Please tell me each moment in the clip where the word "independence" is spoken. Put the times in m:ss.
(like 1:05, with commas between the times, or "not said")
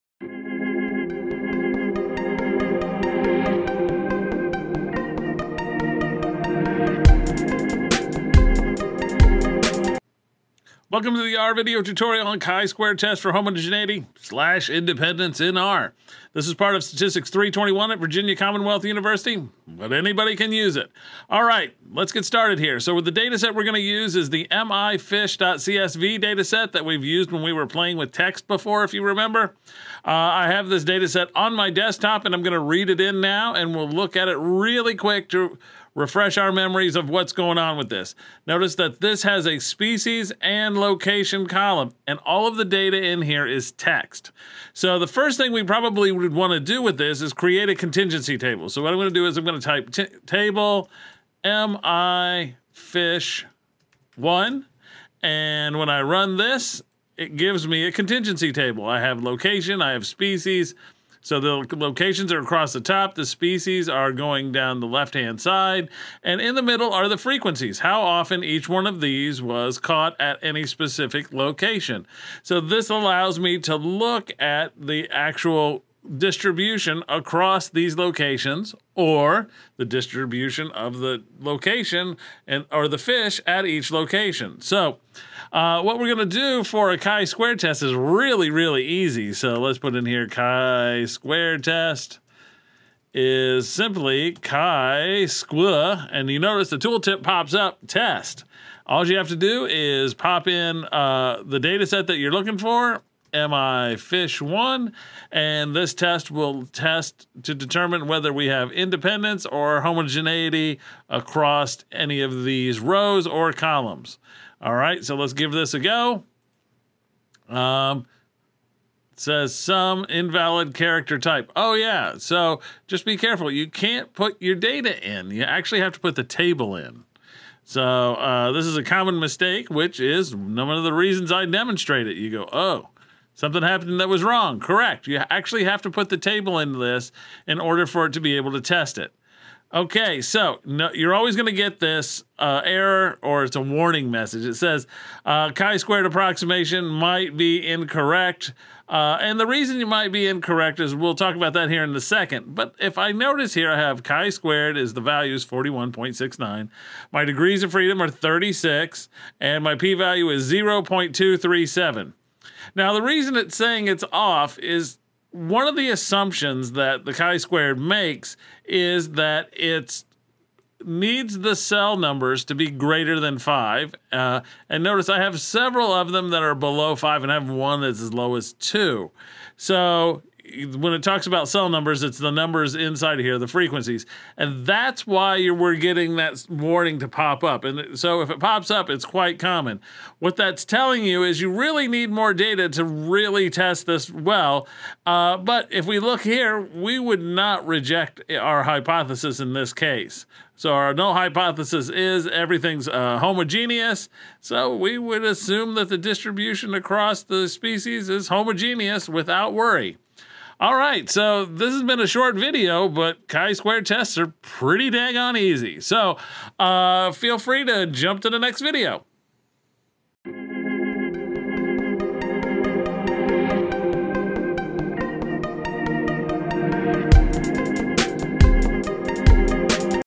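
0:14, 1:48.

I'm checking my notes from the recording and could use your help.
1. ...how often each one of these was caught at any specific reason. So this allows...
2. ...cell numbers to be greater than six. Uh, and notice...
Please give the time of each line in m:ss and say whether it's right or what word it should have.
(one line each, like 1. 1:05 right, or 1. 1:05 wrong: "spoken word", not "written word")
1. 1:07 wrong: "location", not "reason"
2. 2:51 wrong: "five", not "six".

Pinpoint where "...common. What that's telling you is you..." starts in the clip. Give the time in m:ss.
3:09.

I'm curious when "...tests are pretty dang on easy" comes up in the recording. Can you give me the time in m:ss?
3:33.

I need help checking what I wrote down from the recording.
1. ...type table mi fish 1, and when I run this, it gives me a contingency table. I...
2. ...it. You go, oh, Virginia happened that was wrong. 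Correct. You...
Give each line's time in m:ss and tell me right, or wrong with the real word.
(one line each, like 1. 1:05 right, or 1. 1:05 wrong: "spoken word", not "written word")
1. 0:49 right
2. 2:12 wrong: "Something", not "Virginia".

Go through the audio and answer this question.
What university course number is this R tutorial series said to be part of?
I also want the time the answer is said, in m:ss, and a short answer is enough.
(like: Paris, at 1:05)
Statistics 321, at 0:16.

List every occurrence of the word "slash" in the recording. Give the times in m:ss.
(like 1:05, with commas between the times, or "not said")
0:14.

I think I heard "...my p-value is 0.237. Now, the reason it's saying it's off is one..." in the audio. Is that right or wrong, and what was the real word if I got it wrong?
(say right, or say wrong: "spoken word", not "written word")
right.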